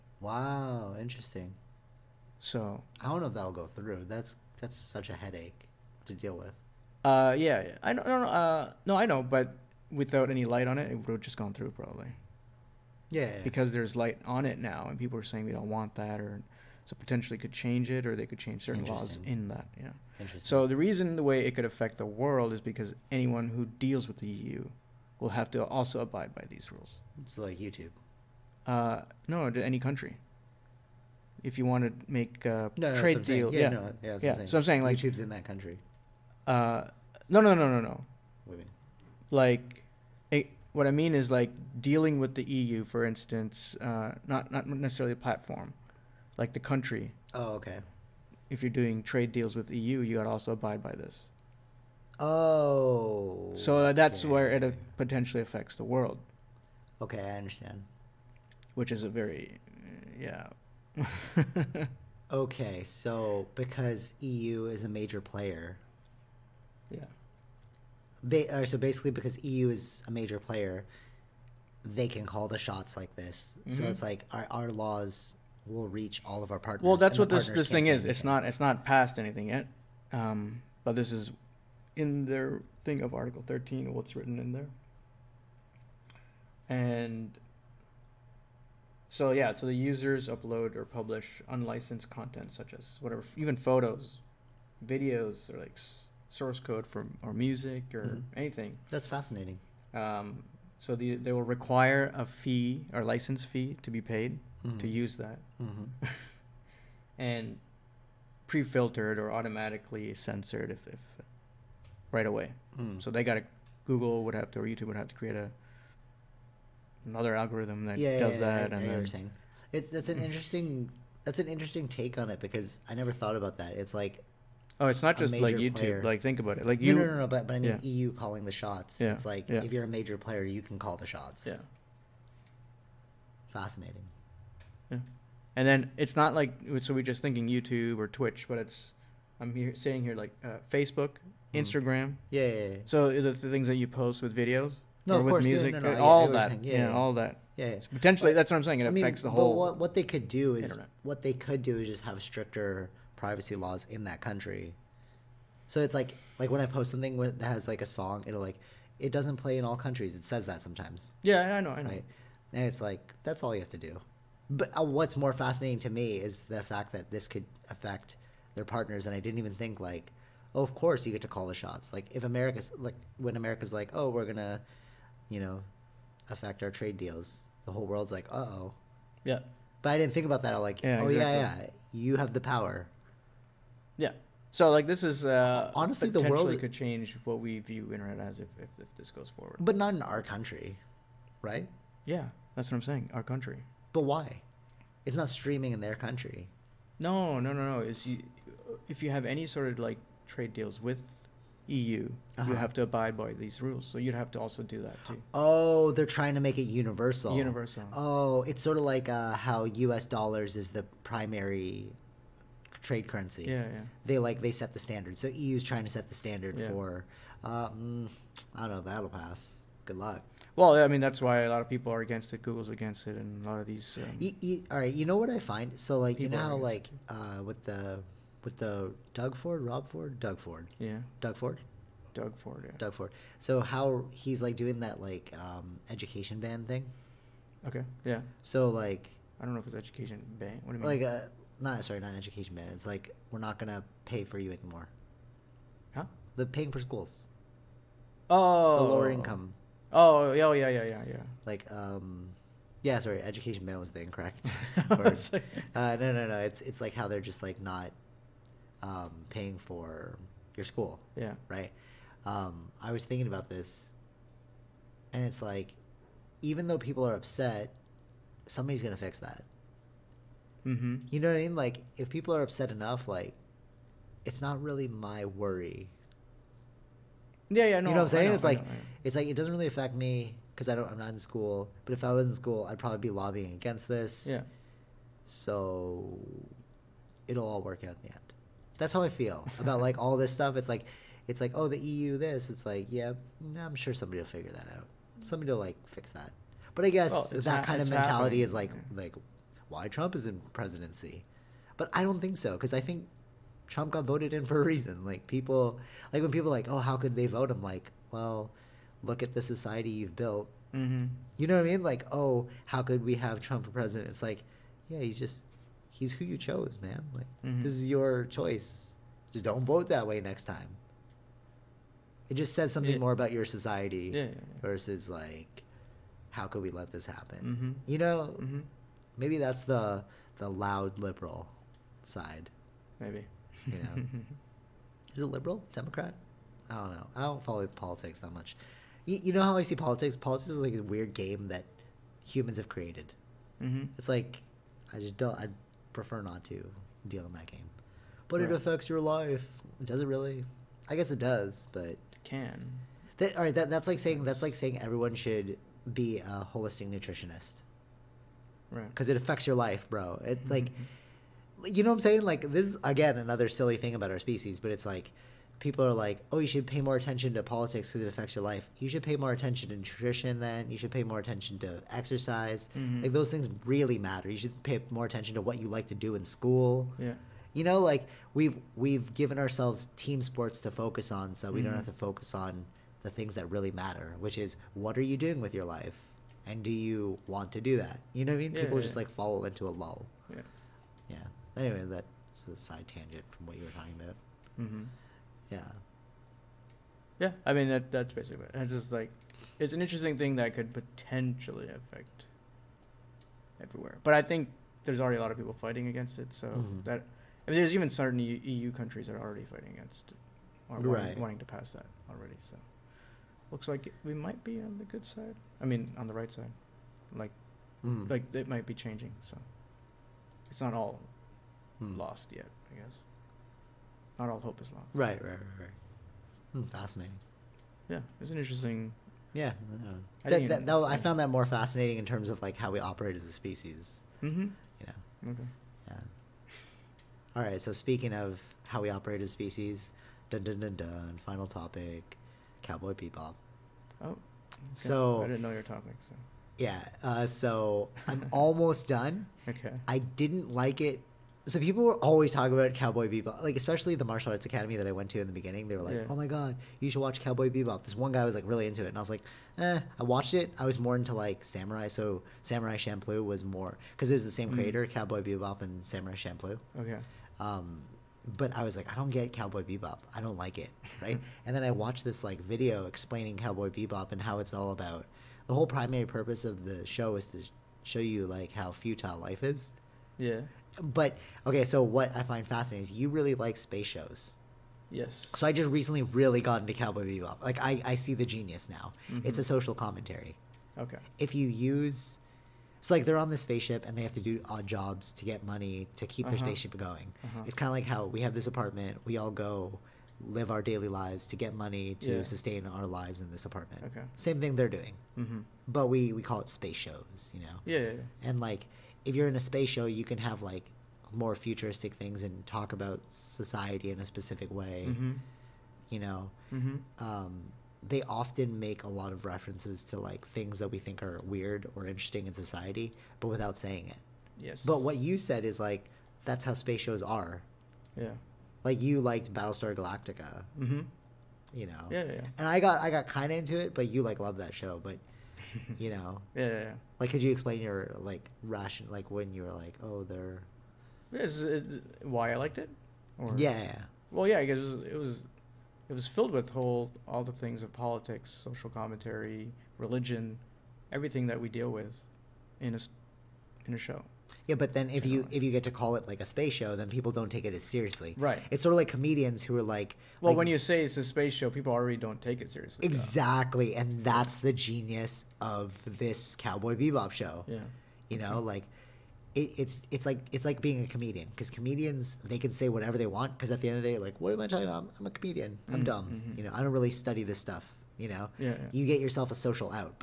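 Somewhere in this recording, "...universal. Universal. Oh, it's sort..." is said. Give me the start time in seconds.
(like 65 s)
206 s.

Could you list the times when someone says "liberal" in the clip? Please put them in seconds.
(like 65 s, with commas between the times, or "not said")
330 s, 335 s.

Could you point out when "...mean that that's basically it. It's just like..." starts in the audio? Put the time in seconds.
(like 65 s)
397 s.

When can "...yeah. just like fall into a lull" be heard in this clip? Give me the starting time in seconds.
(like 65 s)
388 s.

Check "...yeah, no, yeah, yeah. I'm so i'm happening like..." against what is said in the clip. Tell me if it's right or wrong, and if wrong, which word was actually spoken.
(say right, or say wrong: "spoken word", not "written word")
wrong: "saying", not "happening".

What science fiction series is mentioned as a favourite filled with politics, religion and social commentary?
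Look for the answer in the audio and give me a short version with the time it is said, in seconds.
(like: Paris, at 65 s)
Battlestar Galactica, at 529 s.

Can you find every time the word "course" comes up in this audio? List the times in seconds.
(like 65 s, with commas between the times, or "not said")
145 s, 170 s.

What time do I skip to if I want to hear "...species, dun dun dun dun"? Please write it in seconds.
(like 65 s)
439 s.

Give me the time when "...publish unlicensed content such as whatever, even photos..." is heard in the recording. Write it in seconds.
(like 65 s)
90 s.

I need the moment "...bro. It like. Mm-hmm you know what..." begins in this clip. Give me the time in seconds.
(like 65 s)
359 s.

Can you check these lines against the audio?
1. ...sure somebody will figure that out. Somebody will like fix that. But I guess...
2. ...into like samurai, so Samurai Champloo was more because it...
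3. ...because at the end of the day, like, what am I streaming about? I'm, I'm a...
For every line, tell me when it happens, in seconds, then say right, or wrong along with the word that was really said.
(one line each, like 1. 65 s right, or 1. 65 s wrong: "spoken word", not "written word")
1. 293 s right
2. 460 s right
3. 573 s wrong: "talking", not "streaming".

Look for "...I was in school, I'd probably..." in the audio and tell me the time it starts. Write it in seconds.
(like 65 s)
282 s.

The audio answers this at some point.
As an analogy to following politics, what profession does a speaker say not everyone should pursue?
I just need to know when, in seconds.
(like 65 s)
356 s.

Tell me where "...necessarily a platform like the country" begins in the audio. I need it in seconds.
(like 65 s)
44 s.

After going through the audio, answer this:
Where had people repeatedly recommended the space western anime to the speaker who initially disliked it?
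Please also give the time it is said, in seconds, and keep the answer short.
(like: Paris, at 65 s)
Martial arts academy, at 454 s.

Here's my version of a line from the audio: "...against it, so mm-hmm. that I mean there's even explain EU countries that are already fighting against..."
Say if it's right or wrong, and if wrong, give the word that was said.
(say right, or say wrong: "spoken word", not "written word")
wrong: "certain", not "explain".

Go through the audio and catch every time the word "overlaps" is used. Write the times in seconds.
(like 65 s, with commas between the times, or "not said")
not said.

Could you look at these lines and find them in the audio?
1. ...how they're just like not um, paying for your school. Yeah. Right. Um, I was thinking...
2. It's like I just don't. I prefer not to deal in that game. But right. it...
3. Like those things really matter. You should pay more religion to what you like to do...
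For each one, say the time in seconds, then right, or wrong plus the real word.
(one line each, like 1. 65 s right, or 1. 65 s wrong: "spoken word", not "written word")
1. 256 s right
2. 343 s right
3. 373 s wrong: "attention", not "religion".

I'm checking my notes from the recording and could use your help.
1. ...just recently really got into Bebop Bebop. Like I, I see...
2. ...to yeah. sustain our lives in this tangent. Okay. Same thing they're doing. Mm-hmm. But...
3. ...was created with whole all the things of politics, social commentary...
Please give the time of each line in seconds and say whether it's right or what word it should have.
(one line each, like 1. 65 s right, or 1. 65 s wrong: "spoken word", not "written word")
1. 485 s wrong: "Cowboy", not "Bebop"
2. 501 s wrong: "apartment", not "tangent"
3. 545 s wrong: "filled", not "created".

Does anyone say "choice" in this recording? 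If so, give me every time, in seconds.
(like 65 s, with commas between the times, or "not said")
318 s.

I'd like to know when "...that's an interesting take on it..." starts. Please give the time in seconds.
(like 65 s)
121 s.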